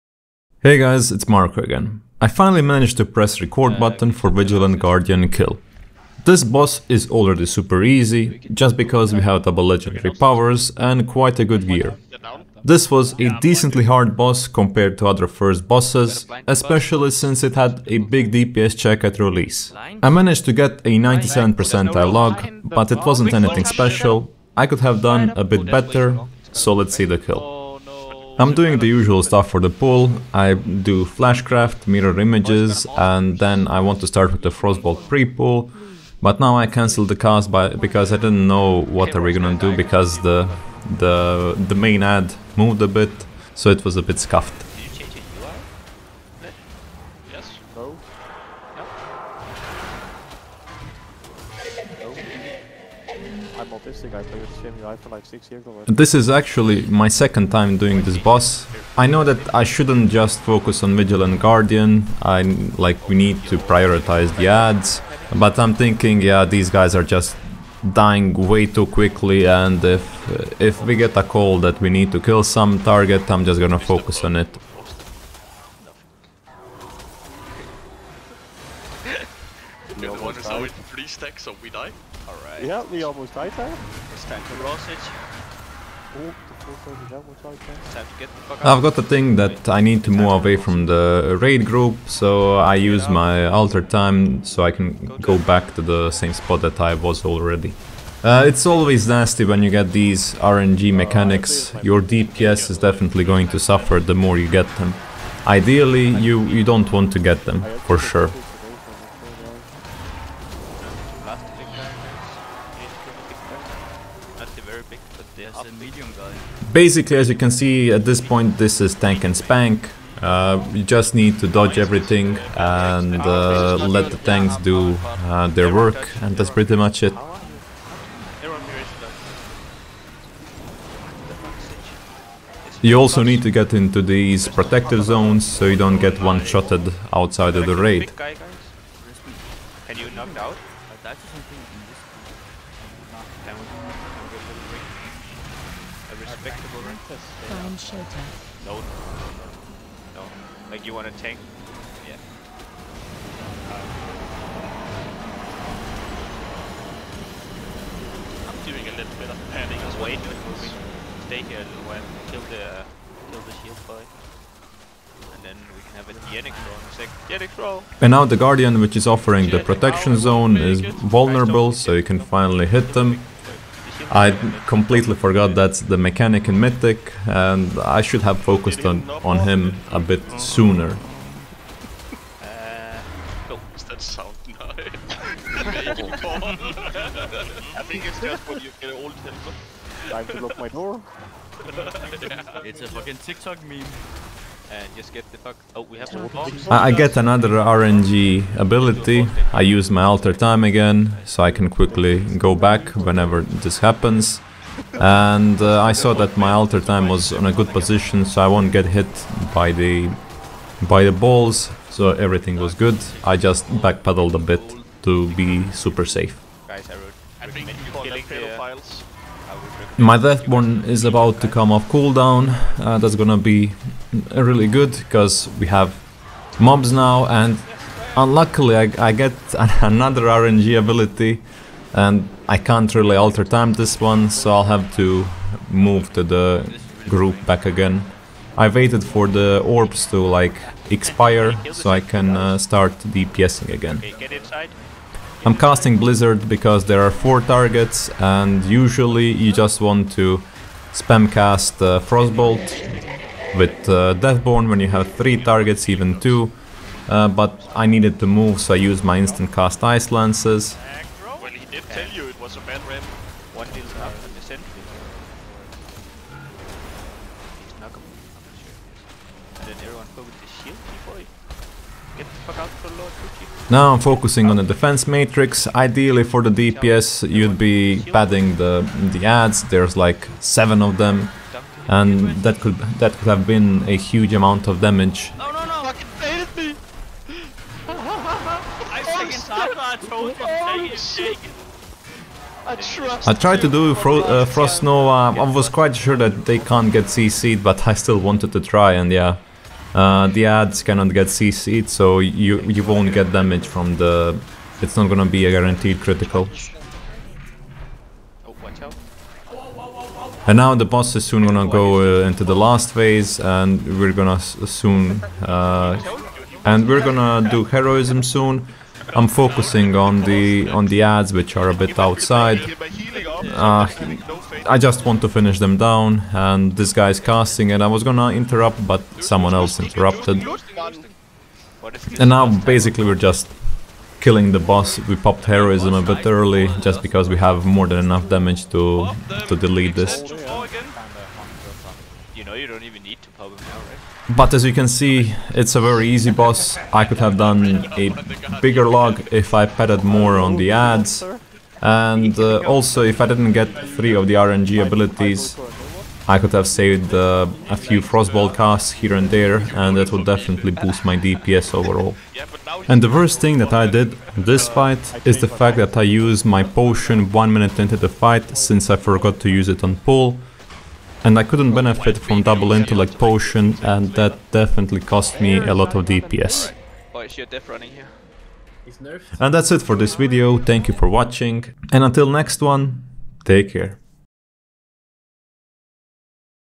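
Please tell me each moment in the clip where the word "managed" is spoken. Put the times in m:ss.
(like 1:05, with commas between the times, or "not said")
0:02, 0:20.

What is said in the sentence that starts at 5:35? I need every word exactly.
We popped heroism a bit early just because we have more than enough damage to, to delete this.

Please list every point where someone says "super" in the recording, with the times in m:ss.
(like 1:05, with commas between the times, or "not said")
0:07, 3:35.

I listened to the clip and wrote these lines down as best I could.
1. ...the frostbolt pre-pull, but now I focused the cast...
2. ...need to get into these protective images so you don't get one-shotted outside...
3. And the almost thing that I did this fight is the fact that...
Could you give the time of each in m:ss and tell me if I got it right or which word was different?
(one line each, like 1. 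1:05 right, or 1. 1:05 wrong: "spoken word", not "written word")
1. 0:34 wrong: "cancelled", not "focused"
2. 2:13 wrong: "zones", not "images"
3. 6:02 wrong: "worst", not "almost".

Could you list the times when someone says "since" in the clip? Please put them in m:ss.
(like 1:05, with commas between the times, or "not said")
0:17, 6:08.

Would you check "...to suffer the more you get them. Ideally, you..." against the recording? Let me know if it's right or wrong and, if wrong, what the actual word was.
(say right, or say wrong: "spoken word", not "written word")
right.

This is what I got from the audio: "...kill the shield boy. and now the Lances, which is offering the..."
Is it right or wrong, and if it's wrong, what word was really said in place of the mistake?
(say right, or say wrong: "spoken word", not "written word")
wrong: "Guardian", not "Lances".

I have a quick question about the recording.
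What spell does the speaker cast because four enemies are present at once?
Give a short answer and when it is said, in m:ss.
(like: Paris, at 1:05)
Blizzard, at 4:05.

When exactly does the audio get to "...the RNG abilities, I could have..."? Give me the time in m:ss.
5:54.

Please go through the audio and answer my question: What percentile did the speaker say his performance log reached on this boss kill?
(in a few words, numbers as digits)
97.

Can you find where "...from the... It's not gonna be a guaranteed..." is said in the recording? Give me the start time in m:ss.
5:03.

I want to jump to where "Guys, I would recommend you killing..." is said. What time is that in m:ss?
3:36.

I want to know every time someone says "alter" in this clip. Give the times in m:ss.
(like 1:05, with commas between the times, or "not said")
1:33, 3:20, 3:26, 3:53.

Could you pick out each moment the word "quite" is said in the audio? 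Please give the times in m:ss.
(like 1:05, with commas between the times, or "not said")
0:11, 4:55.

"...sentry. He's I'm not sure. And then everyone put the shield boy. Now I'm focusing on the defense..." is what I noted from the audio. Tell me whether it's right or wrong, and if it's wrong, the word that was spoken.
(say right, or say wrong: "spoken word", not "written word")
right.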